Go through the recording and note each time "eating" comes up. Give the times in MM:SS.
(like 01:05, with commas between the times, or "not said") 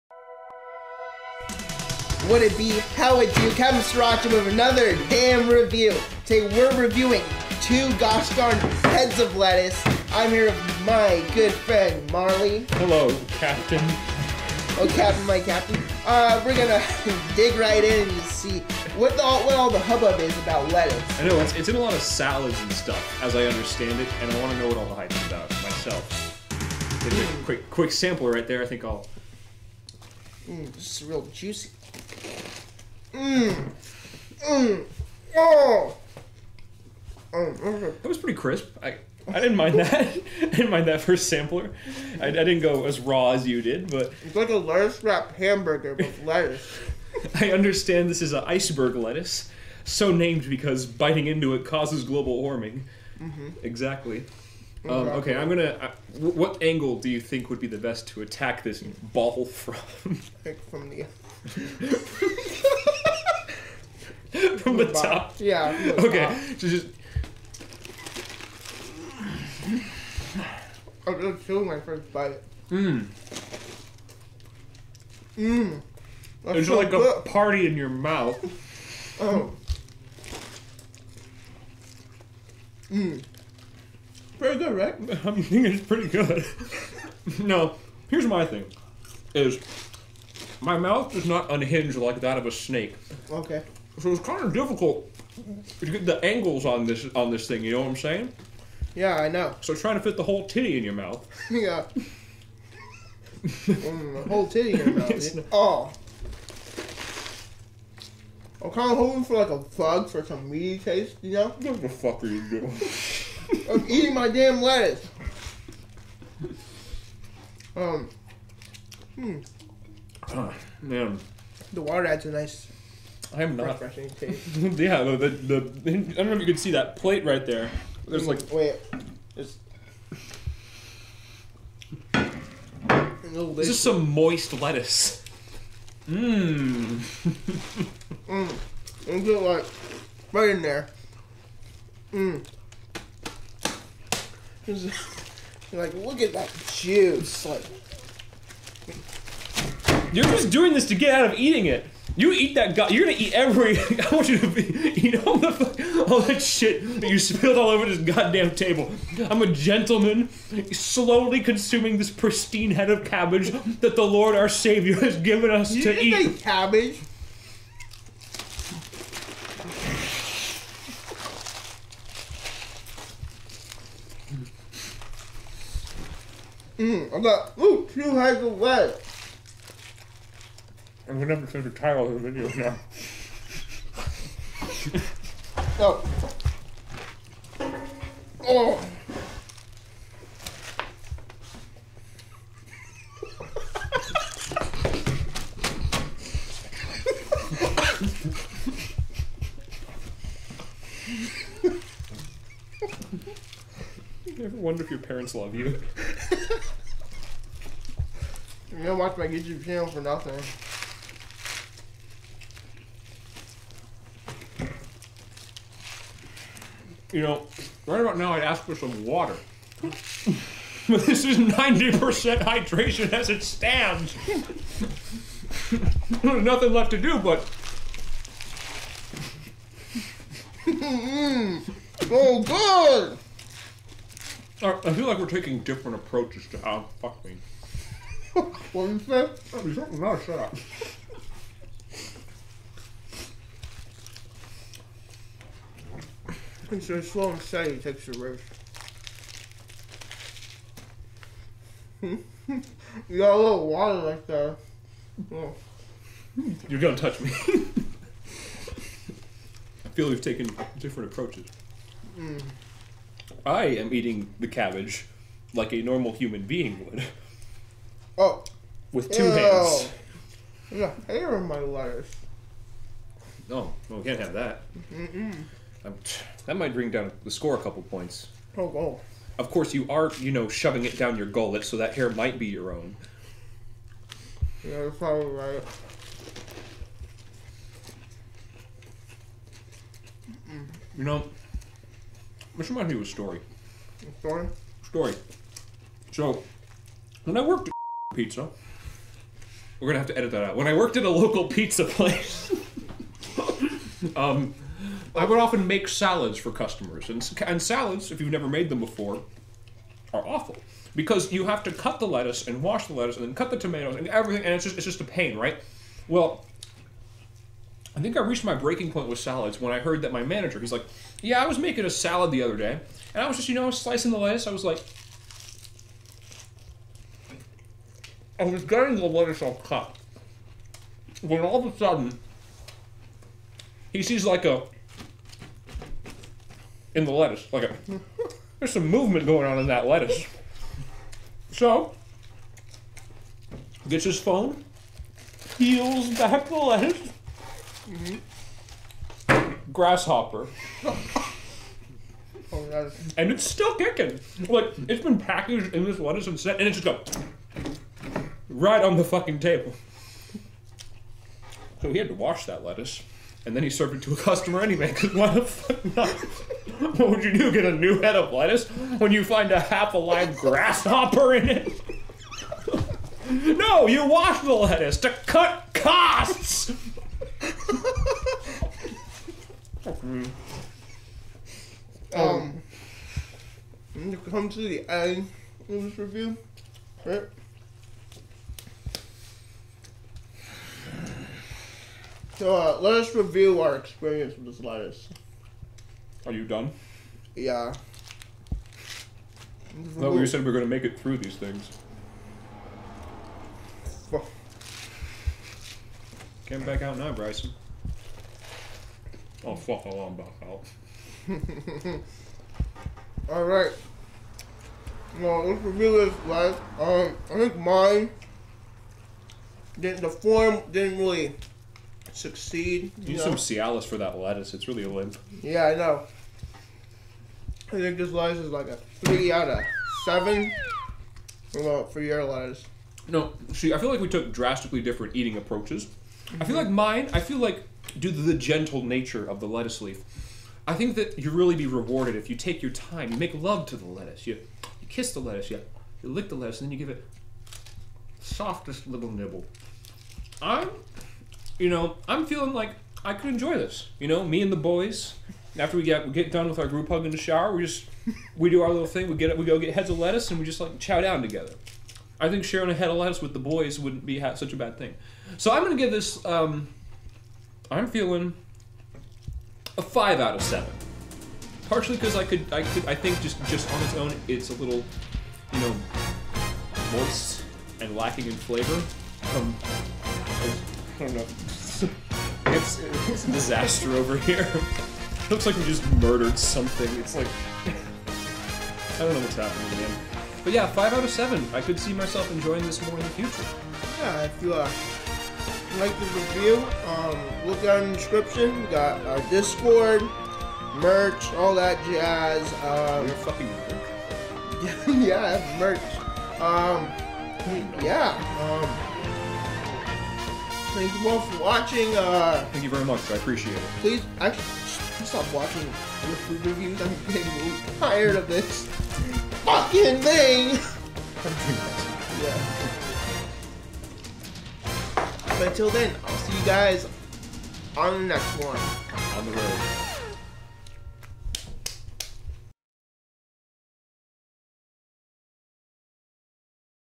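01:53, 02:31, 04:23, 07:15.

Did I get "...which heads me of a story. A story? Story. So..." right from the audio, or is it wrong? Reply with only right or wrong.
wrong.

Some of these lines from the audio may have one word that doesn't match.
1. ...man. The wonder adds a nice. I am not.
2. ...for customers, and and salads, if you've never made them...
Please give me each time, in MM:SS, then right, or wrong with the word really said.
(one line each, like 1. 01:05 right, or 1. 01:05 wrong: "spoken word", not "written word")
1. 02:00 wrong: "water", not "wonder"
2. 05:06 right.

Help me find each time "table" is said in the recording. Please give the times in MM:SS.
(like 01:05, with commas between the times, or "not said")
02:38, 05:59.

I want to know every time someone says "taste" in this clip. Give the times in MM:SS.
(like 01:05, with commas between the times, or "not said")
01:50, 02:04.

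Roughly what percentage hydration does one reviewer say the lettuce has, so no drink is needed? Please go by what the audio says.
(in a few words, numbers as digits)
90%.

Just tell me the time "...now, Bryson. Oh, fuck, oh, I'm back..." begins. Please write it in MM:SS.
06:46.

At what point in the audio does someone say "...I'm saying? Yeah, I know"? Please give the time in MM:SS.
01:37.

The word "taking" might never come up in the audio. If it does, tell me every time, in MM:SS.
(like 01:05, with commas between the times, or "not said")
03:55.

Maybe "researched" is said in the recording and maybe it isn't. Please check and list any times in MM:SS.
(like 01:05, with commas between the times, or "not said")
not said.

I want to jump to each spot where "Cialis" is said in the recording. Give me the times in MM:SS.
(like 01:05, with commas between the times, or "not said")
07:03.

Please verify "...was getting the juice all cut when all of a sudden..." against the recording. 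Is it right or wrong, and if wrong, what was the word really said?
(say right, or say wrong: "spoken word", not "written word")
wrong: "lettuce", not "juice".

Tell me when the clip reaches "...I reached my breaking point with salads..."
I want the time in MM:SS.
05:18.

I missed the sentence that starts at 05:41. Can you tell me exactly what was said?
So gets his phone, peels back the lettuce.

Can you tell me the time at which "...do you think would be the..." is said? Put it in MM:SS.
00:56.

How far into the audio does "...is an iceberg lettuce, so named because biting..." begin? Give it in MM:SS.
00:48.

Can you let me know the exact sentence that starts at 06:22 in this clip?
um, to come to the end of this review, right?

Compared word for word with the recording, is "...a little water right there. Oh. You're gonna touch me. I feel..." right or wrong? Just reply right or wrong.
right.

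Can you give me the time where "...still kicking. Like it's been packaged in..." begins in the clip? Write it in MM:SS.
05:53.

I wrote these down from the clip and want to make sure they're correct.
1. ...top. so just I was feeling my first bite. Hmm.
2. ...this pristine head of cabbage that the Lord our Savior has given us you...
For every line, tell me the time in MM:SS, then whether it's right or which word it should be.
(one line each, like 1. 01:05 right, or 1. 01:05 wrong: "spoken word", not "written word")
1. 01:06 wrong: "chilling", not "feeling"
2. 02:41 right.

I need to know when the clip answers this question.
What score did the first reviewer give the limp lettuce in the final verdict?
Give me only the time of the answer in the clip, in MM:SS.
07:09.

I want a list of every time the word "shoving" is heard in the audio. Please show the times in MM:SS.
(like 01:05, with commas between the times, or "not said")
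04:40.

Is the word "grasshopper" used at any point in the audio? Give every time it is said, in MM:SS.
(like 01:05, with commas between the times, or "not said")
05:49, 06:10.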